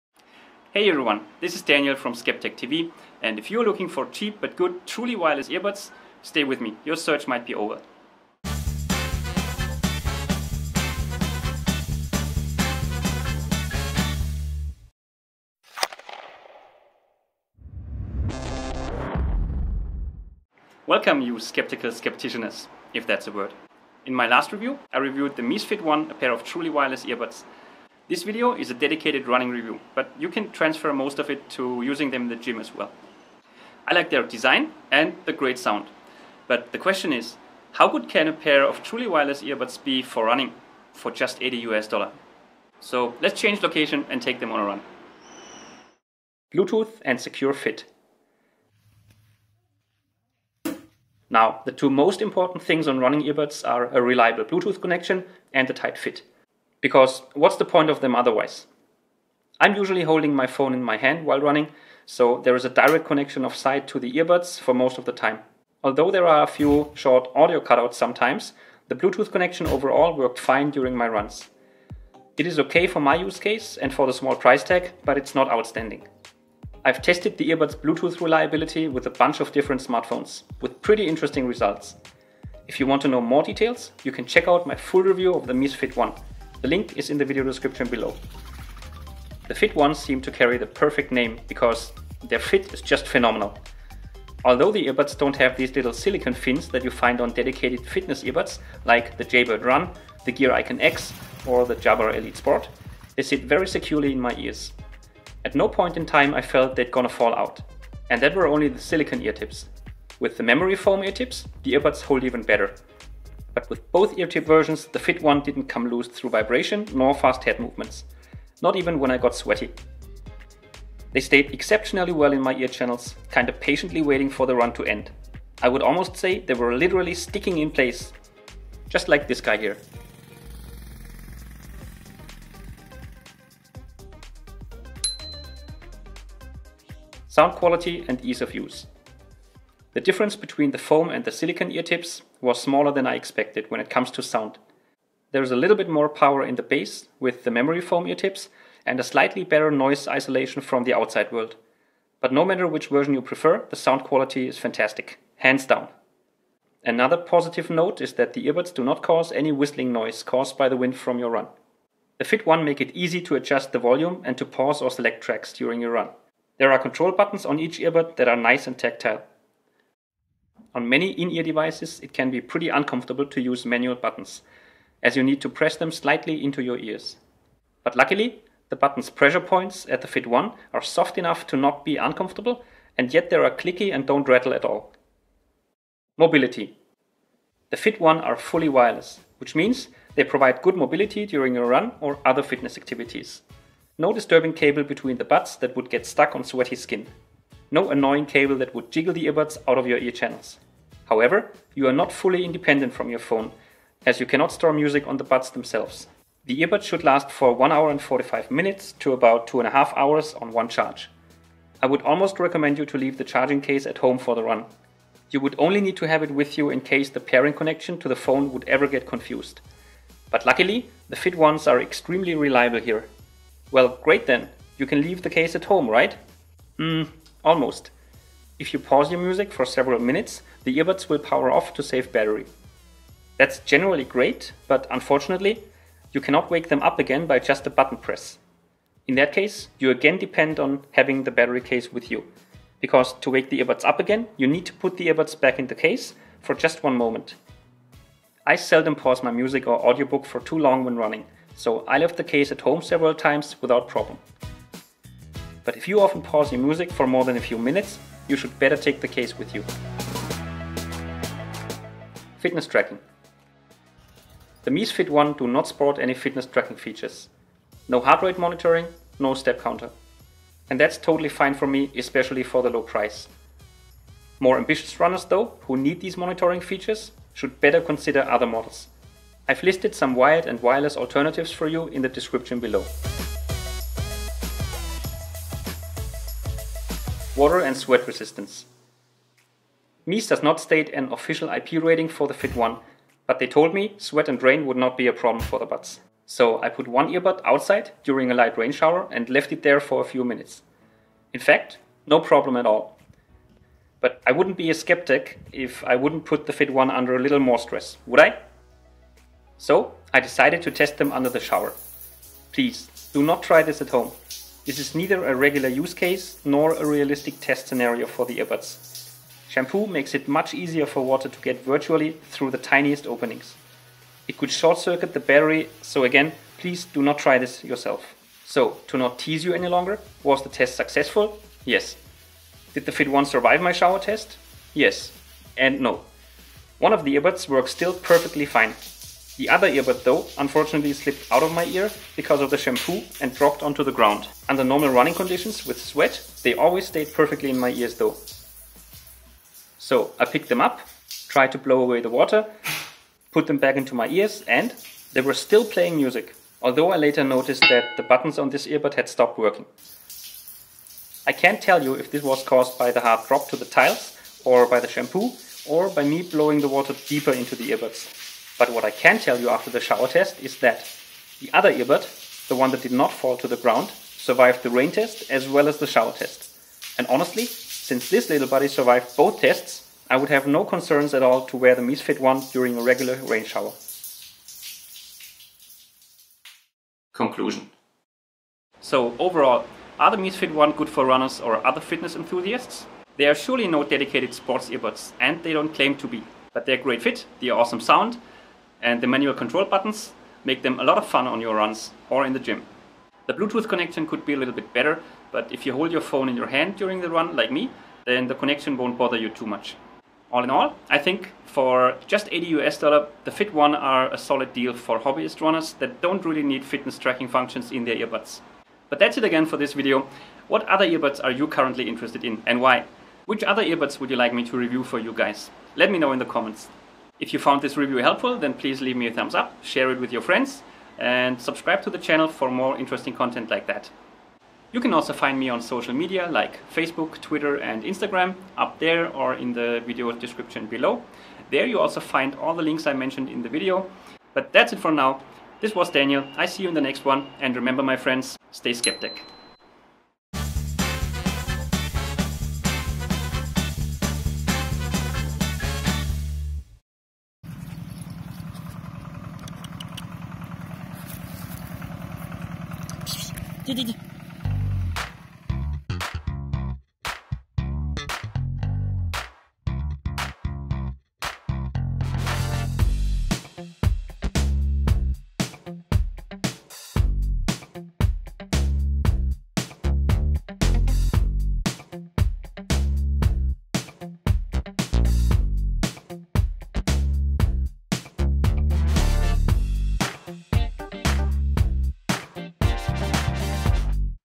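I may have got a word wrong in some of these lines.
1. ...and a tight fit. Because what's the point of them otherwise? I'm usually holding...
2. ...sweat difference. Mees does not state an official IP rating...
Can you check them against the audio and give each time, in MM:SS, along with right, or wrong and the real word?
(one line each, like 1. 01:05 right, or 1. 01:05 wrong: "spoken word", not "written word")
1. 00:55 right
2. 04:47 wrong: "resistance", not "difference".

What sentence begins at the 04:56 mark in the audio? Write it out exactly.
So I put one earbud outside during a light rain shower and left it there for a few minutes.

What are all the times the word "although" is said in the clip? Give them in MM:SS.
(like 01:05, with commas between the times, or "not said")
01:05, 01:34, 05:56.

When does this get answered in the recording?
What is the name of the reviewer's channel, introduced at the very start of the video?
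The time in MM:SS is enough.
00:02.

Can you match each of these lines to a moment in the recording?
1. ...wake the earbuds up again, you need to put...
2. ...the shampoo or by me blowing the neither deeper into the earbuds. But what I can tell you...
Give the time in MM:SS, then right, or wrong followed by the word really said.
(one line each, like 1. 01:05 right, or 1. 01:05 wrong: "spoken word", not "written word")
1. 04:03 right
2. 06:04 wrong: "water", not "neither".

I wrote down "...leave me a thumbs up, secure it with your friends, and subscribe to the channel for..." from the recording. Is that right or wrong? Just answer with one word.
wrong.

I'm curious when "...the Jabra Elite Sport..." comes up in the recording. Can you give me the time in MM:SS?
01:41.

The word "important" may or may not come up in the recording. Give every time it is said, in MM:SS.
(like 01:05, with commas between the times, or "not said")
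00:52.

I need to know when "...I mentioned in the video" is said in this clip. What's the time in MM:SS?
07:22.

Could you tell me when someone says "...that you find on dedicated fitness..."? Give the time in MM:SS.
01:36.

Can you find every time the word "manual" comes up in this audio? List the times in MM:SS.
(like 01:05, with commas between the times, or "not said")
02:53, 06:39.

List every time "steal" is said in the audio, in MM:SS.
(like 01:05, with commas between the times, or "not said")
not said.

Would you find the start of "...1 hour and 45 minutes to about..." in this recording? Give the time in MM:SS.
03:27.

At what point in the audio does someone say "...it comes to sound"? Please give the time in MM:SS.
02:23.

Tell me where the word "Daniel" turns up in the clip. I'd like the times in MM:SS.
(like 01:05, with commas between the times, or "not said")
00:01, 07:25.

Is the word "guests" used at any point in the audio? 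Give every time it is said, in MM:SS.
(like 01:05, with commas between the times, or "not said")
not said.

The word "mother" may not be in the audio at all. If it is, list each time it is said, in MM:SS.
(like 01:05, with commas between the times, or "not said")
not said.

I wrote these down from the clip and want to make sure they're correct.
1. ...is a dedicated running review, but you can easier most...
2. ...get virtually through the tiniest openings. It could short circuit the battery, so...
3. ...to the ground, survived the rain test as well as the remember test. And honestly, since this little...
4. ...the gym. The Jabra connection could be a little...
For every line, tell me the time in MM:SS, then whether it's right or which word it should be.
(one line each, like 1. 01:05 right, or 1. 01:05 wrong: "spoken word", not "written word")
1. 00:28 wrong: "transfer", not "easier"
2. 05:21 right
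3. 06:13 wrong: "shower", not "remember"
4. 06:42 wrong: "Bluetooth", not "Jabra".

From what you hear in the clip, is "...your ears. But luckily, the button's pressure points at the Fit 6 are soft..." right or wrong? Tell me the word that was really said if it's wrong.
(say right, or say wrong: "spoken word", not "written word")
wrong: "1", not "6".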